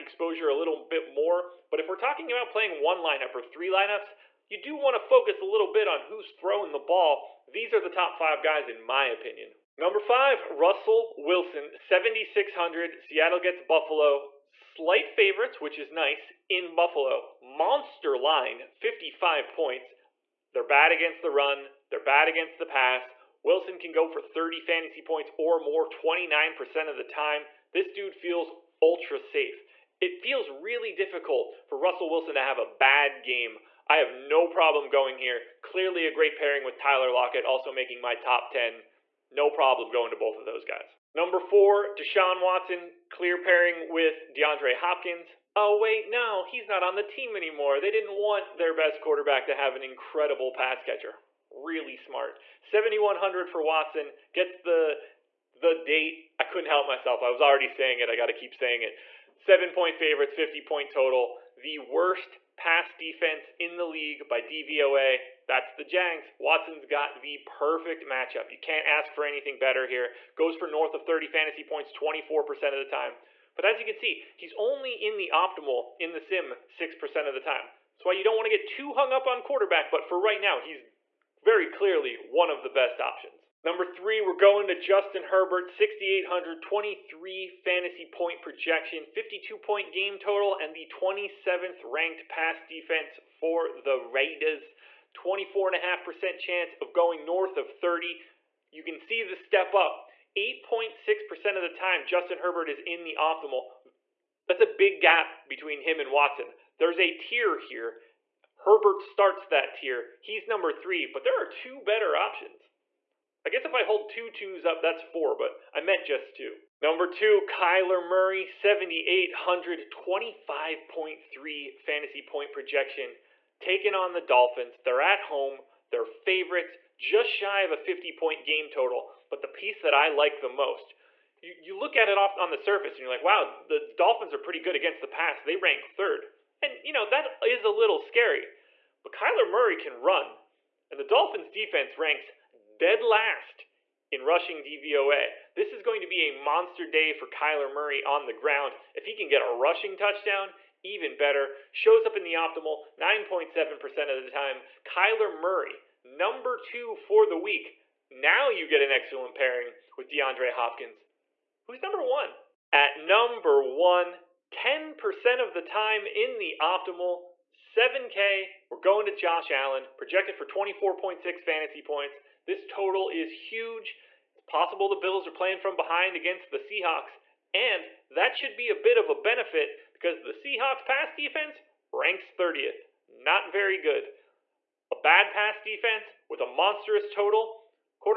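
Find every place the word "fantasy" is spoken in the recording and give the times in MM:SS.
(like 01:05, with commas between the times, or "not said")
00:24, 01:11, 01:27, 02:01, 02:51.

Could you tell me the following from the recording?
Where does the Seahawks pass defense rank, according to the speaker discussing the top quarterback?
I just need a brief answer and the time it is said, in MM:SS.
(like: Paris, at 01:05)
30th, at 03:02.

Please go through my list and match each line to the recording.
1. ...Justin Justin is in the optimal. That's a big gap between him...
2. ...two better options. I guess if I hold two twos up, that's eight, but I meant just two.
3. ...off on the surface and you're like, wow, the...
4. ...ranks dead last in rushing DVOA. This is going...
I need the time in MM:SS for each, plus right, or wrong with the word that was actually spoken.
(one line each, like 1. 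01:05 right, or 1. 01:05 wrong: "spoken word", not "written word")
1. 01:42 wrong: "Herbert", not "Justin"
2. 01:51 wrong: "four", not "eight"
3. 02:12 right
4. 02:21 right.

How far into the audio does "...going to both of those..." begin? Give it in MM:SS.
00:39.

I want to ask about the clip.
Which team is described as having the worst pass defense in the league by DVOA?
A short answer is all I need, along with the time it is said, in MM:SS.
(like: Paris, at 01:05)
The Jags, at 01:05.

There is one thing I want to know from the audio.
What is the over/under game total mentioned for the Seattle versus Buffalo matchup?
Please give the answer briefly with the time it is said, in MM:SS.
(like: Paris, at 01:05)
55 points, at 00:18.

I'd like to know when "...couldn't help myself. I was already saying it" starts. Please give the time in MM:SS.
00:56.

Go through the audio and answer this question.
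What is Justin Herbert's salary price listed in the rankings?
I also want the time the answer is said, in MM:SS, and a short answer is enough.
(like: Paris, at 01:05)
6,800, at 01:25.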